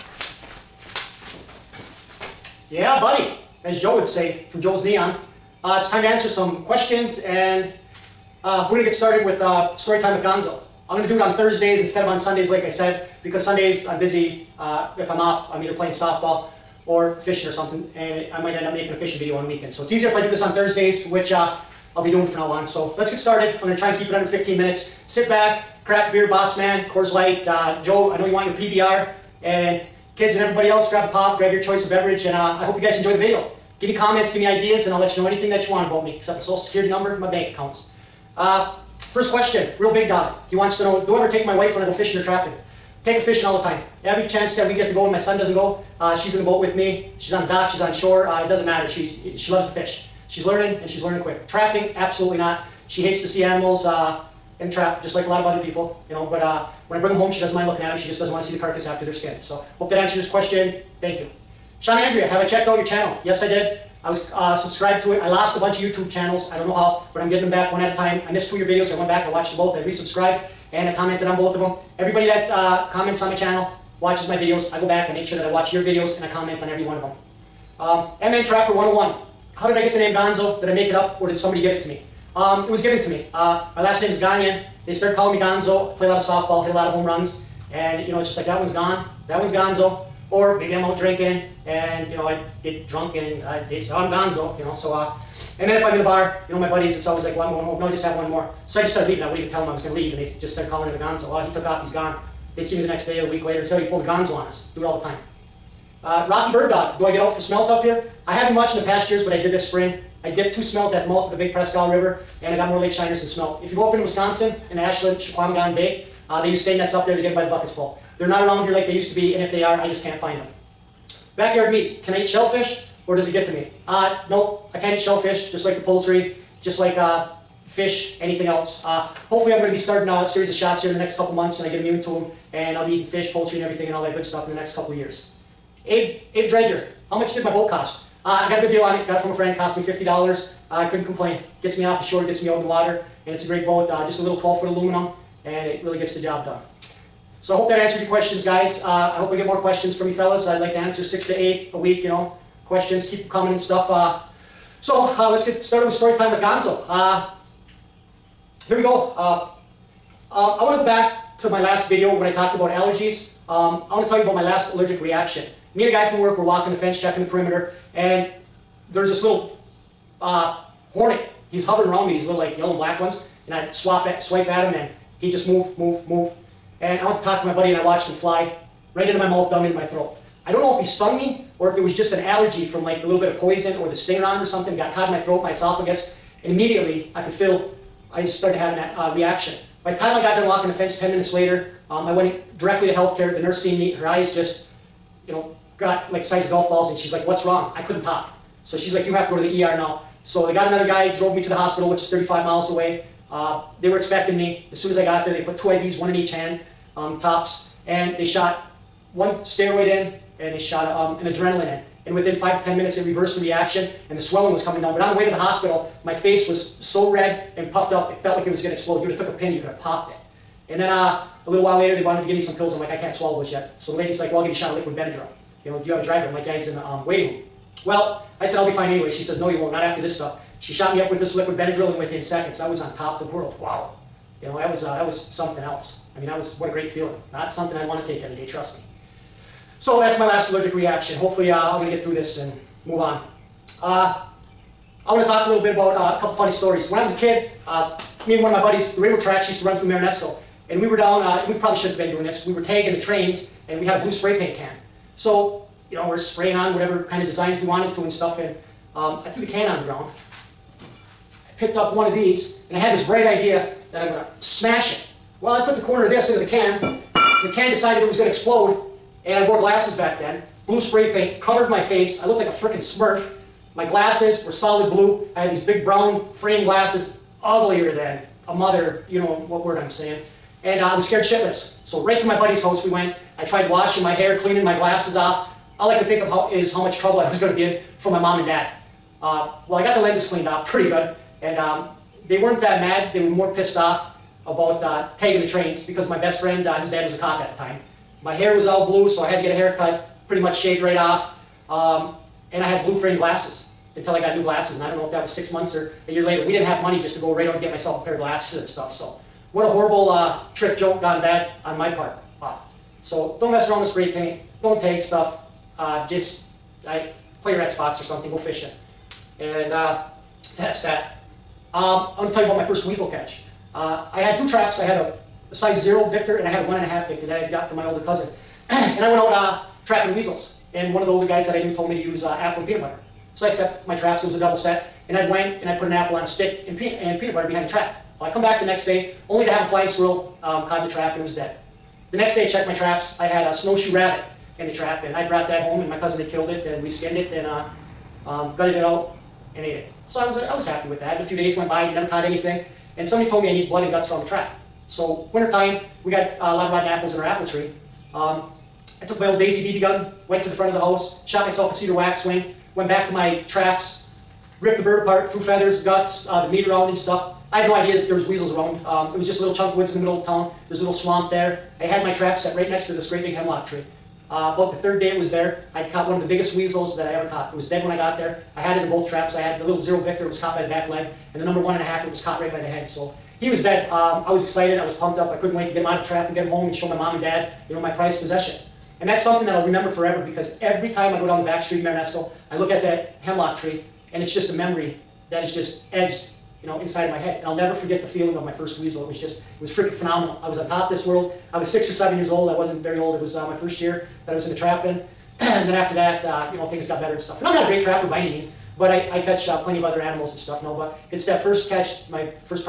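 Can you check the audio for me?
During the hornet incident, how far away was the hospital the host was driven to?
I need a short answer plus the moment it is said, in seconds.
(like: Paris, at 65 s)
35 miles, at 202 s.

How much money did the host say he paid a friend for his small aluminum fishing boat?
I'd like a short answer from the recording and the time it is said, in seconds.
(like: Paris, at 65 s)
$50, at 139 s.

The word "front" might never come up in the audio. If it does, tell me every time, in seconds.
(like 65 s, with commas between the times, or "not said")
360 s.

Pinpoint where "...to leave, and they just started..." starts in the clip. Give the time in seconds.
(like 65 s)
99 s.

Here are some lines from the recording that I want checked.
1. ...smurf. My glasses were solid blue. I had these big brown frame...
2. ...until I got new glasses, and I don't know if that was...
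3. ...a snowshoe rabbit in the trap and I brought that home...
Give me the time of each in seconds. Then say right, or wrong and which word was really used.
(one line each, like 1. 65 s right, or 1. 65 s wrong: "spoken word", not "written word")
1. 272 s right
2. 303 s right
3. 343 s right.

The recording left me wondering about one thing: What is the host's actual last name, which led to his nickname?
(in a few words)
Gagnon.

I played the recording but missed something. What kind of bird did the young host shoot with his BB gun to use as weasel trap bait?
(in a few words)
cedar waxwing.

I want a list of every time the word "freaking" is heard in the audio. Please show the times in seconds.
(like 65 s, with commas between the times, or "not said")
272 s, 399 s.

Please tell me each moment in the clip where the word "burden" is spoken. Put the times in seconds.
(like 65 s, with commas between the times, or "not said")
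not said.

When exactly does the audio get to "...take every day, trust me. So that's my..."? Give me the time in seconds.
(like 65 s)
238 s.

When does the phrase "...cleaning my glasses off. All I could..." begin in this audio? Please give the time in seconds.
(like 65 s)
284 s.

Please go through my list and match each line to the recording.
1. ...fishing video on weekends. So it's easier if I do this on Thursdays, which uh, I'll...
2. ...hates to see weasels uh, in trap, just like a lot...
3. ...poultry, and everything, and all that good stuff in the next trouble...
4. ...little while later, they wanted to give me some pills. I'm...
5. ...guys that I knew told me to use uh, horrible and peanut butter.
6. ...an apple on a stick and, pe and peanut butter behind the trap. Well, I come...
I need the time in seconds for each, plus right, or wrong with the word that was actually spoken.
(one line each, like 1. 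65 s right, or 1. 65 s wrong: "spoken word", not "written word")
1. 18 s right
2. 53 s wrong: "animals", not "weasels"
3. 133 s wrong: "couple", not "trouble"
4. 221 s right
5. 331 s wrong: "apple", not "horrible"
6. 335 s right.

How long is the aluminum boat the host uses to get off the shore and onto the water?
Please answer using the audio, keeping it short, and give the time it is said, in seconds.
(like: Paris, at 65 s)
12-foot, at 144 s.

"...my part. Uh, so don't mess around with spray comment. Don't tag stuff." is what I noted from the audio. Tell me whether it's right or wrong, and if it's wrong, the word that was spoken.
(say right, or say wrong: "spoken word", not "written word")
wrong: "paint", not "comment".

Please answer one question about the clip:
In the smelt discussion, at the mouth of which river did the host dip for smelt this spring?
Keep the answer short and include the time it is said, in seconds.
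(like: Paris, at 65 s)
Big Prescott River, at 111 s.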